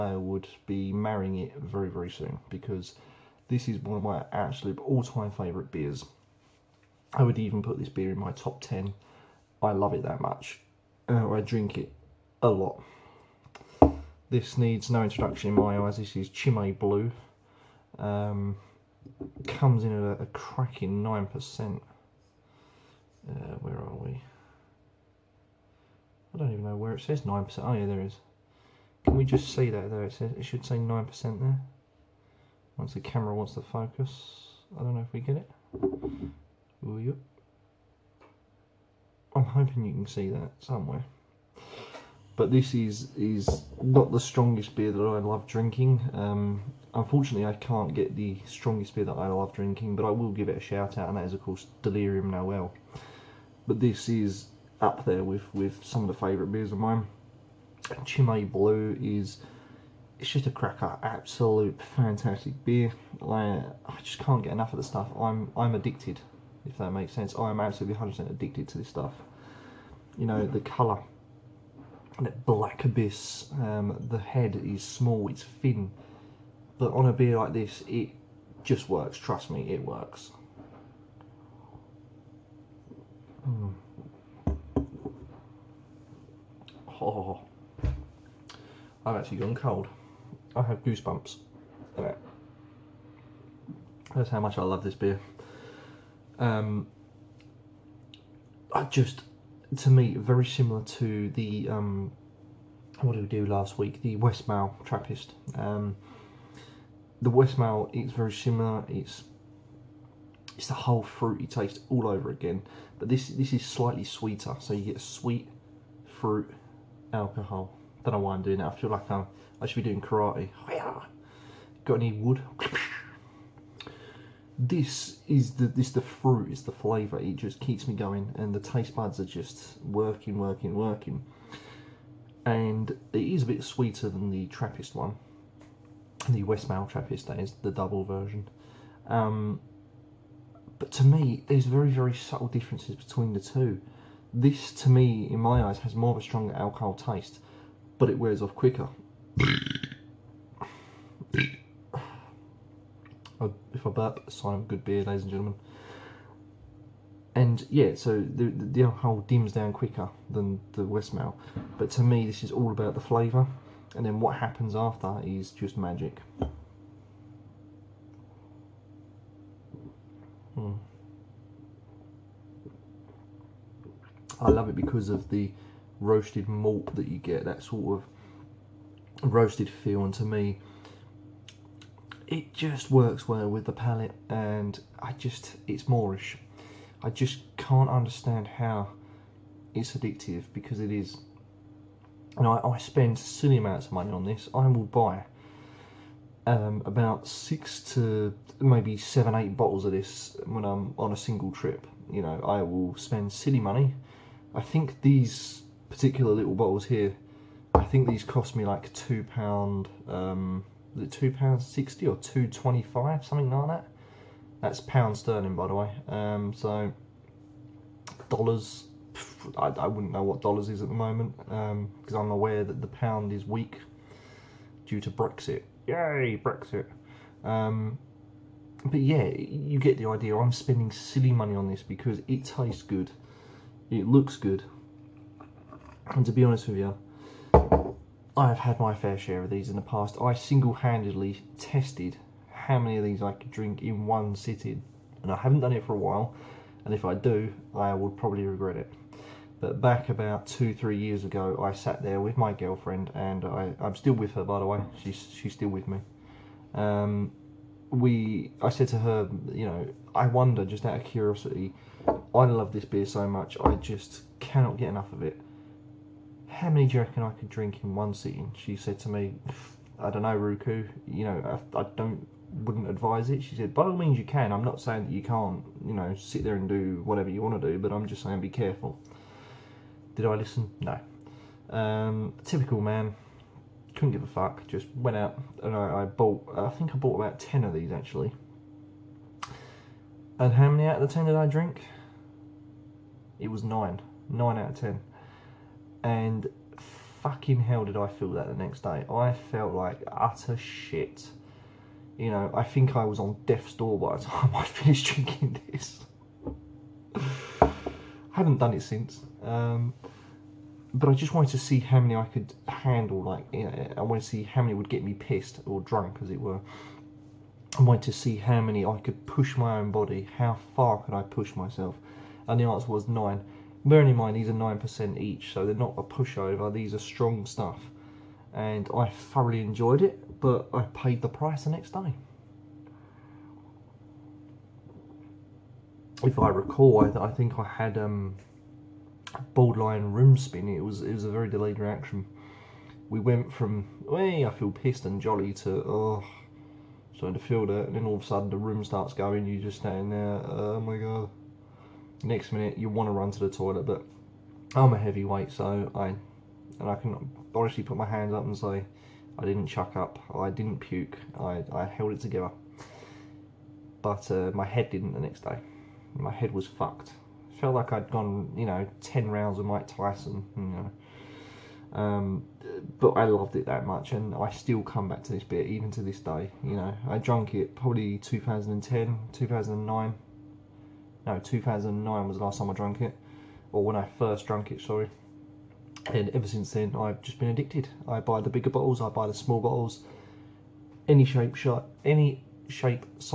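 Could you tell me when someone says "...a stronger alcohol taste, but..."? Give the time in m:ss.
2:26.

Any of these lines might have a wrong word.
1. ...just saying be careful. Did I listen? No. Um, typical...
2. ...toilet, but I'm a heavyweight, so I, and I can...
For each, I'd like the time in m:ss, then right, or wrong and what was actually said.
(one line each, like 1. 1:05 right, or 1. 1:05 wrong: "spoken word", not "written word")
1. 4:38 right
2. 5:53 right.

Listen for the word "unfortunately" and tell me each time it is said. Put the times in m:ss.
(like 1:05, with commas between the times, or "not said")
0:46.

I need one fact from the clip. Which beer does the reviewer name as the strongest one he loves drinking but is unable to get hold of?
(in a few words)
Delirium Noel.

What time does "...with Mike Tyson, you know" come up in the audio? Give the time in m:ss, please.
6:09.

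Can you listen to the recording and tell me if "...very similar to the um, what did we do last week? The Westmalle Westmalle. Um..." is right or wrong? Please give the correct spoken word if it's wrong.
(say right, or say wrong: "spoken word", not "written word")
wrong: "Trappist", not "Westmalle".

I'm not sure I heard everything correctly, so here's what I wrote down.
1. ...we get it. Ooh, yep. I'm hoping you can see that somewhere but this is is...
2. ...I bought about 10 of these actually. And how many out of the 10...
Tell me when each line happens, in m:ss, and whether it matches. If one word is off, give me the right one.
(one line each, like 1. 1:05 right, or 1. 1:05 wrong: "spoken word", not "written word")
1. 0:35 right
2. 4:46 right.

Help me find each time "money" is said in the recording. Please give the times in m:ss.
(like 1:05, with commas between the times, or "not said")
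3:13, 3:23, 3:51.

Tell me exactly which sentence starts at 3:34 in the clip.
That's pound sterling, by the way.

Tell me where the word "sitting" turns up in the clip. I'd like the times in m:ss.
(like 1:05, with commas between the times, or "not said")
4:04, 4:28.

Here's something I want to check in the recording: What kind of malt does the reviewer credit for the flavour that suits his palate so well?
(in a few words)
roasted malt.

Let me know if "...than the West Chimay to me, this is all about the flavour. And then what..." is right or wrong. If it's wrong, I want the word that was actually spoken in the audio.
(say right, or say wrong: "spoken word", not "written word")
wrong: "But", not "Chimay".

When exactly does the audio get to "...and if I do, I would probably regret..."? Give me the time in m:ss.
4:06.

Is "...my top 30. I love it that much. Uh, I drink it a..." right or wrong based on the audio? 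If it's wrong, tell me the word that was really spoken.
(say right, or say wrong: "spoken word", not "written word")
wrong: "10", not "30".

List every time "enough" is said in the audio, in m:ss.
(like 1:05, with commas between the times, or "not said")
1:04, 4:24.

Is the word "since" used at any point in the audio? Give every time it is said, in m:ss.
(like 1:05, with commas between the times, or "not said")
5:08, 6:26.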